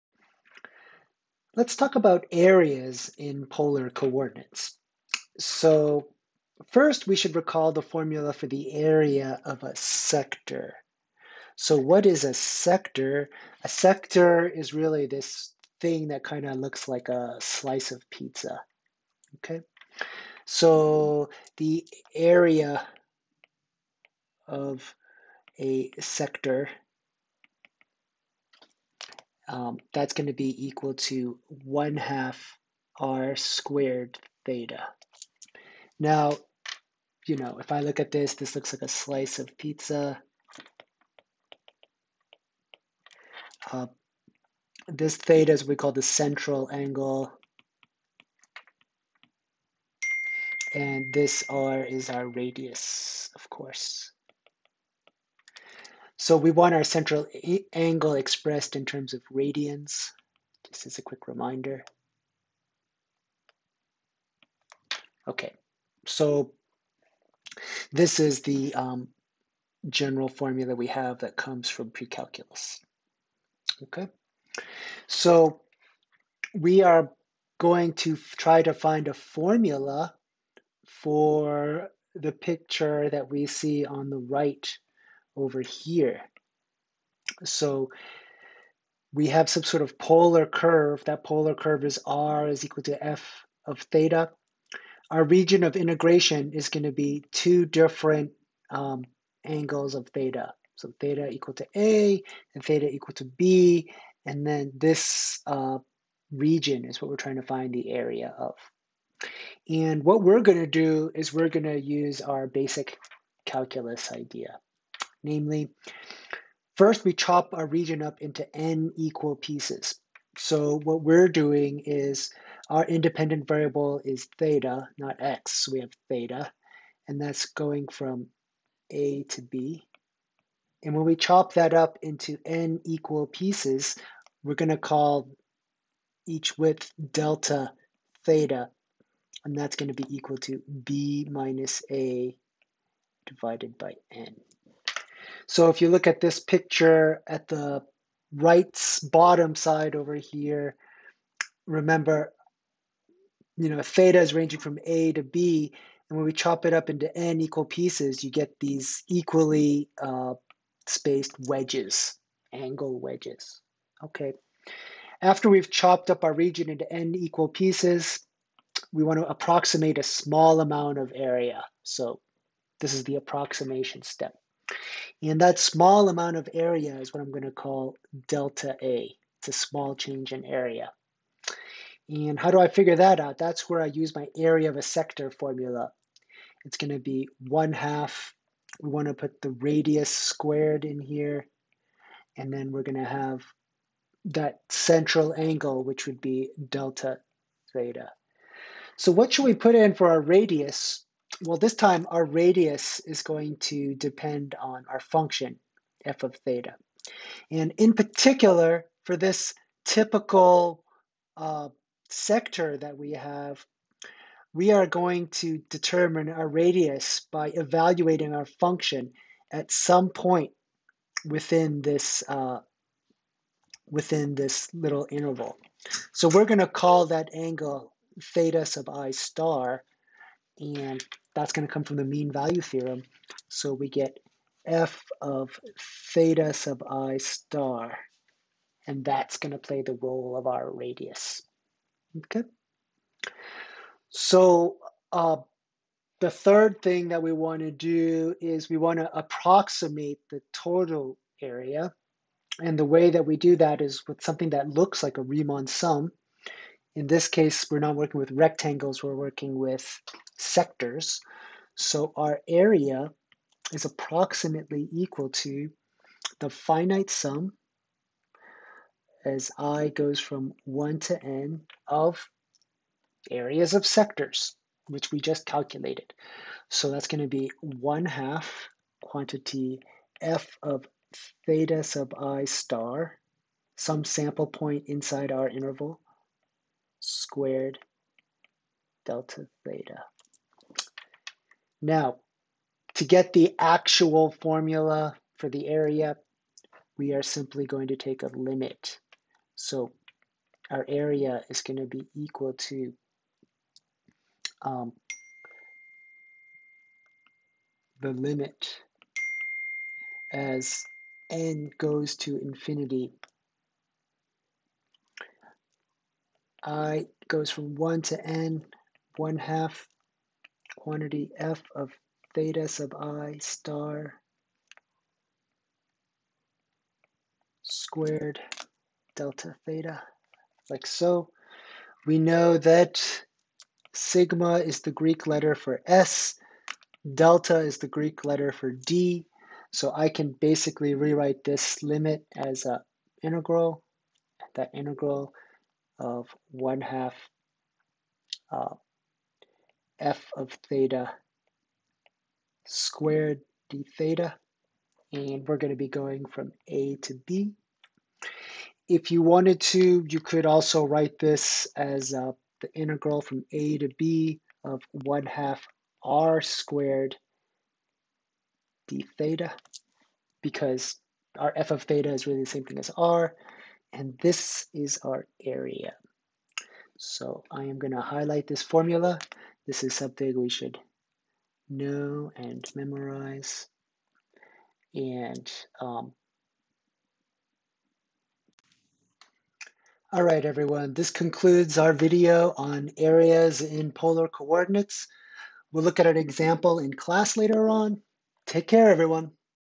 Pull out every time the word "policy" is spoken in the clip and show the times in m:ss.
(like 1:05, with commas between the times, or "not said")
not said.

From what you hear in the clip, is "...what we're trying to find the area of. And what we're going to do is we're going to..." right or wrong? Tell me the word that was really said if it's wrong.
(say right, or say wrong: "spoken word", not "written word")
right.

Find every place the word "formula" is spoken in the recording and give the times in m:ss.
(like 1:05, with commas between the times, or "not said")
0:07, 1:10, 1:19, 3:05, 4:54, 6:18.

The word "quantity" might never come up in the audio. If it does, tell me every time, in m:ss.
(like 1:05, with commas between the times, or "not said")
4:39, 5:20.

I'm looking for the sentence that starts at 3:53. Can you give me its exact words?
So we get f of theta sub i star, and that's going to play the role of our radius.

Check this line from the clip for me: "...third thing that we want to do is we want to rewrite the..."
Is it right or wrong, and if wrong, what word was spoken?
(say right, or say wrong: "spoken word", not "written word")
wrong: "approximate", not "rewrite".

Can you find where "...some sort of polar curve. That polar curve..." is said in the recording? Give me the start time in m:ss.
1:29.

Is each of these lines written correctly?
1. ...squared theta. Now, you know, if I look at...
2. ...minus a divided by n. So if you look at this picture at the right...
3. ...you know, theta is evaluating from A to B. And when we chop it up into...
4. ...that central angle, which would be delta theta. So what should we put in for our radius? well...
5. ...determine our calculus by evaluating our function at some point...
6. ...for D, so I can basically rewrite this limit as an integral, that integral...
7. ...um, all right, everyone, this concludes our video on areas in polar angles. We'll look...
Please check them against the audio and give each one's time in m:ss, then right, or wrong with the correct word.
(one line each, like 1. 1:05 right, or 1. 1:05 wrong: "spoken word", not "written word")
1. 0:33 right
2. 2:21 right
3. 2:33 wrong: "ranging", not "evaluating"
4. 3:14 right
5. 3:35 wrong: "radius", not "calculus"
6. 5:38 right
7. 6:25 wrong: "coordinates", not "angles".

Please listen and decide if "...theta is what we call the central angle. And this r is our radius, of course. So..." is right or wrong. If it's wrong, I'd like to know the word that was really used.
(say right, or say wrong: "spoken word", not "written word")
right.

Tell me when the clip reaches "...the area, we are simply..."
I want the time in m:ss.
4:55.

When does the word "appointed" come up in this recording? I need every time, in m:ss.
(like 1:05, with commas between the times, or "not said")
not said.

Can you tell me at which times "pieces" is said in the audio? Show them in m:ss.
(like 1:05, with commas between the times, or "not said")
1:59, 2:13, 2:37, 2:47.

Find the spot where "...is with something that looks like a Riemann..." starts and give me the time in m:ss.
4:13.